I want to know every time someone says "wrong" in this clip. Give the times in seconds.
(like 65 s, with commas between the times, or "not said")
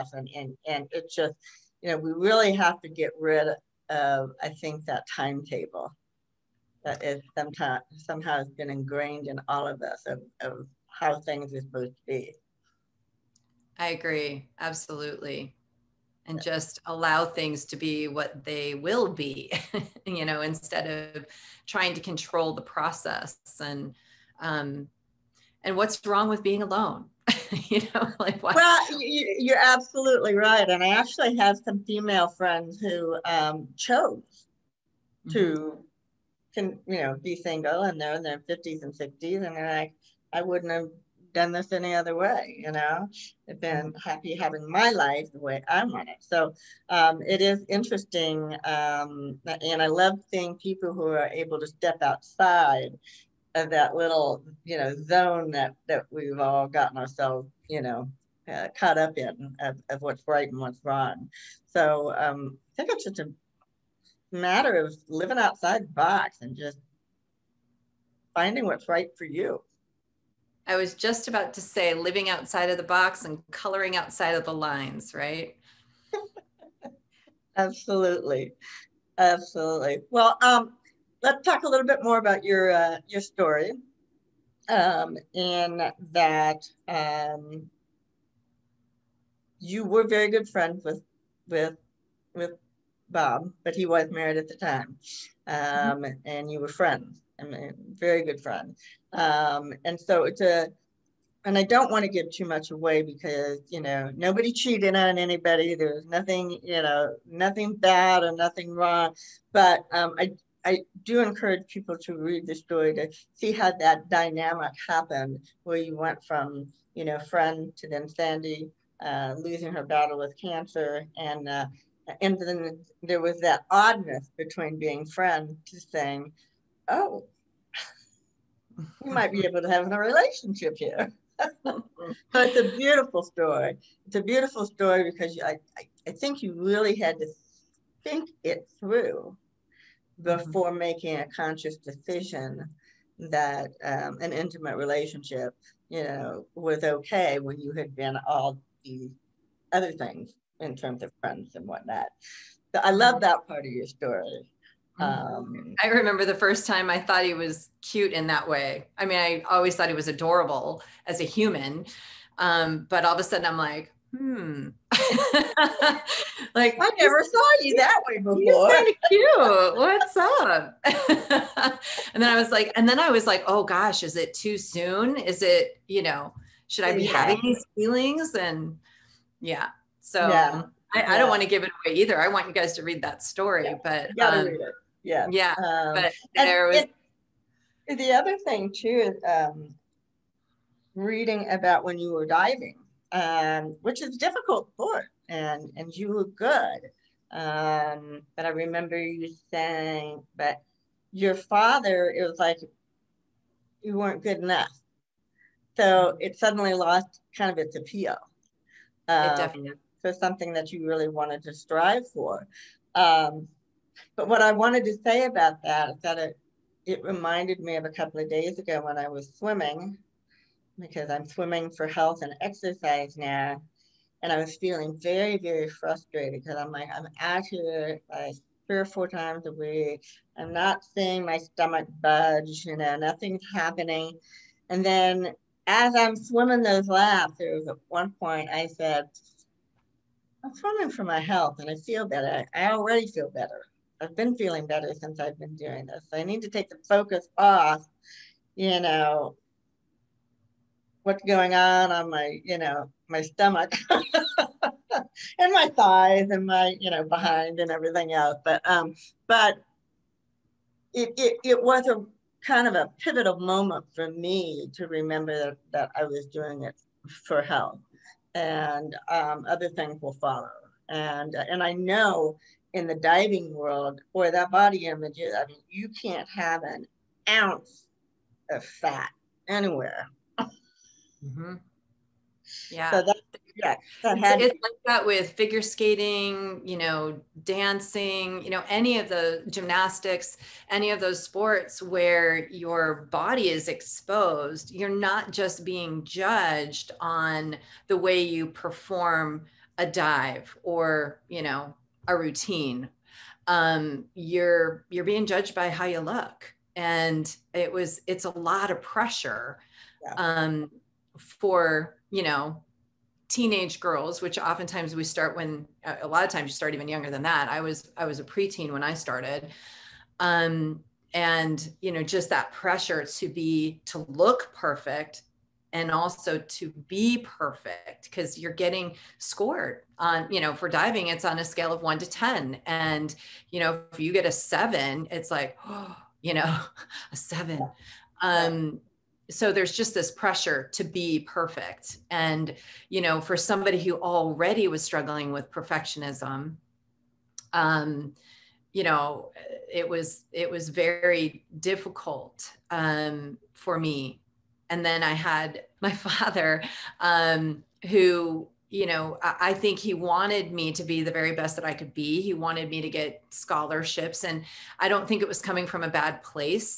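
26 s, 60 s, 108 s.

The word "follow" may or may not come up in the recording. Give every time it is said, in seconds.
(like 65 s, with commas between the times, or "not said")
270 s.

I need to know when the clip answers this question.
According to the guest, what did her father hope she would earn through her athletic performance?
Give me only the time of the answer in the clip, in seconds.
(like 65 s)
363 s.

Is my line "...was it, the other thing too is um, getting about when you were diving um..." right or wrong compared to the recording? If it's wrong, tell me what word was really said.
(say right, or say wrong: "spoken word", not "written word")
wrong: "reading", not "getting".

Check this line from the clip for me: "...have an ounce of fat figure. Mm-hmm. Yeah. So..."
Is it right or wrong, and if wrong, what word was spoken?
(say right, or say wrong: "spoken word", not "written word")
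wrong: "anywhere", not "figure".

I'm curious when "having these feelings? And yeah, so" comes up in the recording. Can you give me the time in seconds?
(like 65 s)
177 s.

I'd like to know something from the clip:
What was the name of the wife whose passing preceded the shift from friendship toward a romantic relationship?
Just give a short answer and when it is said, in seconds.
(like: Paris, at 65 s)
Sandy, at 118 s.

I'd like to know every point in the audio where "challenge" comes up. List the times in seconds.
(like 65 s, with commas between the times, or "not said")
not said.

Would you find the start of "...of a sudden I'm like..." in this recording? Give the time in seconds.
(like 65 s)
163 s.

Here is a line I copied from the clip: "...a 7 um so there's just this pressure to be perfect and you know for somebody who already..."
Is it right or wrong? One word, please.
right.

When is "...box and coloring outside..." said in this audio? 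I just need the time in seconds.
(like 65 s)
72 s.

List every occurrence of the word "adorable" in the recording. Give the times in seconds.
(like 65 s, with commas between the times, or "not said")
160 s.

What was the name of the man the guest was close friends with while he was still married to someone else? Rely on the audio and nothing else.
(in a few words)
Bob.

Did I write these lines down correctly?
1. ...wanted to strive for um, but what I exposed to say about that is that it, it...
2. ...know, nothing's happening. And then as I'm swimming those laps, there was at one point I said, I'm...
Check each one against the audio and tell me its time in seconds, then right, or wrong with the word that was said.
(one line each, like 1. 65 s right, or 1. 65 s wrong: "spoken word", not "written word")
1. 211 s wrong: "wanted", not "exposed"
2. 232 s right.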